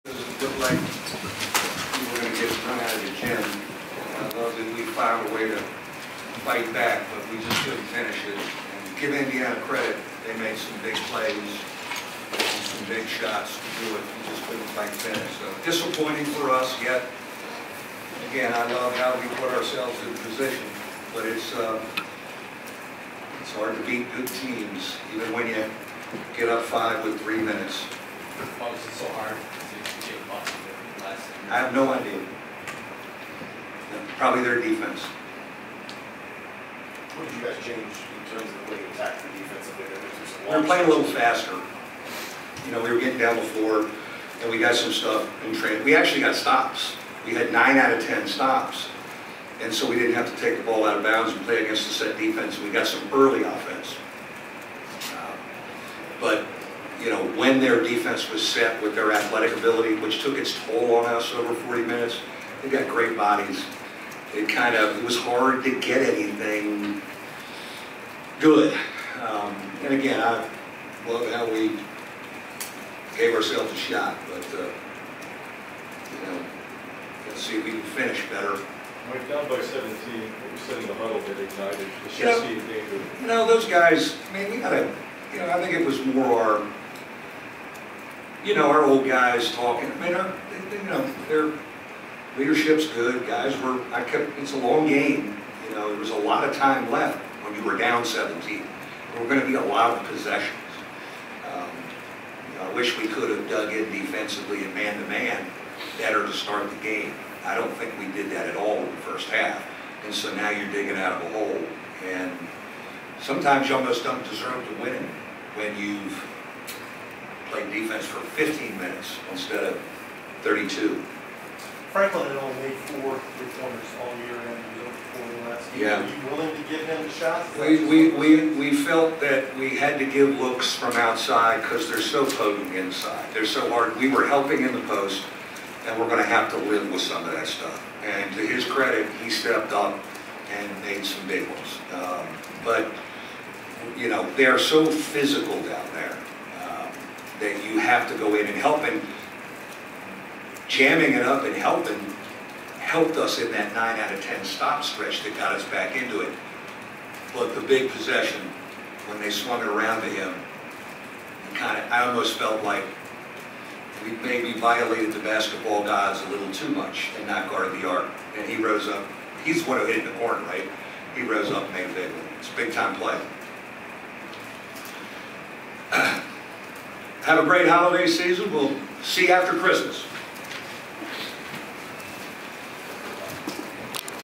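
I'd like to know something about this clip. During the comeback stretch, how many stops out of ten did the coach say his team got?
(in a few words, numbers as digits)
9.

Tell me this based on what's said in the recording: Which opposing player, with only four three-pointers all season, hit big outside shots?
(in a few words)
Franklin.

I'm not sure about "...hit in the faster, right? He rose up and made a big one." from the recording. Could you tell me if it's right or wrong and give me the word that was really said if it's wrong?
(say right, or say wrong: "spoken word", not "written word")
wrong: "corner", not "faster".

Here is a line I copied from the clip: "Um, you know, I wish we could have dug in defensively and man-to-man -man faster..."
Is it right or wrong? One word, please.
wrong.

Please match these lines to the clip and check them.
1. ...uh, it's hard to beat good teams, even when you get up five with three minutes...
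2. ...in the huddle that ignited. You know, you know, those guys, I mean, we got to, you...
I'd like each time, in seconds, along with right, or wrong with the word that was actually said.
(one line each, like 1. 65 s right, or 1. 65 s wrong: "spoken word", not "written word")
1. 21 s right
2. 80 s right.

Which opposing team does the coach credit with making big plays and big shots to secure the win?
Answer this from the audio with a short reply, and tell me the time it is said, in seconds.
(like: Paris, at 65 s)
Indiana, at 9 s.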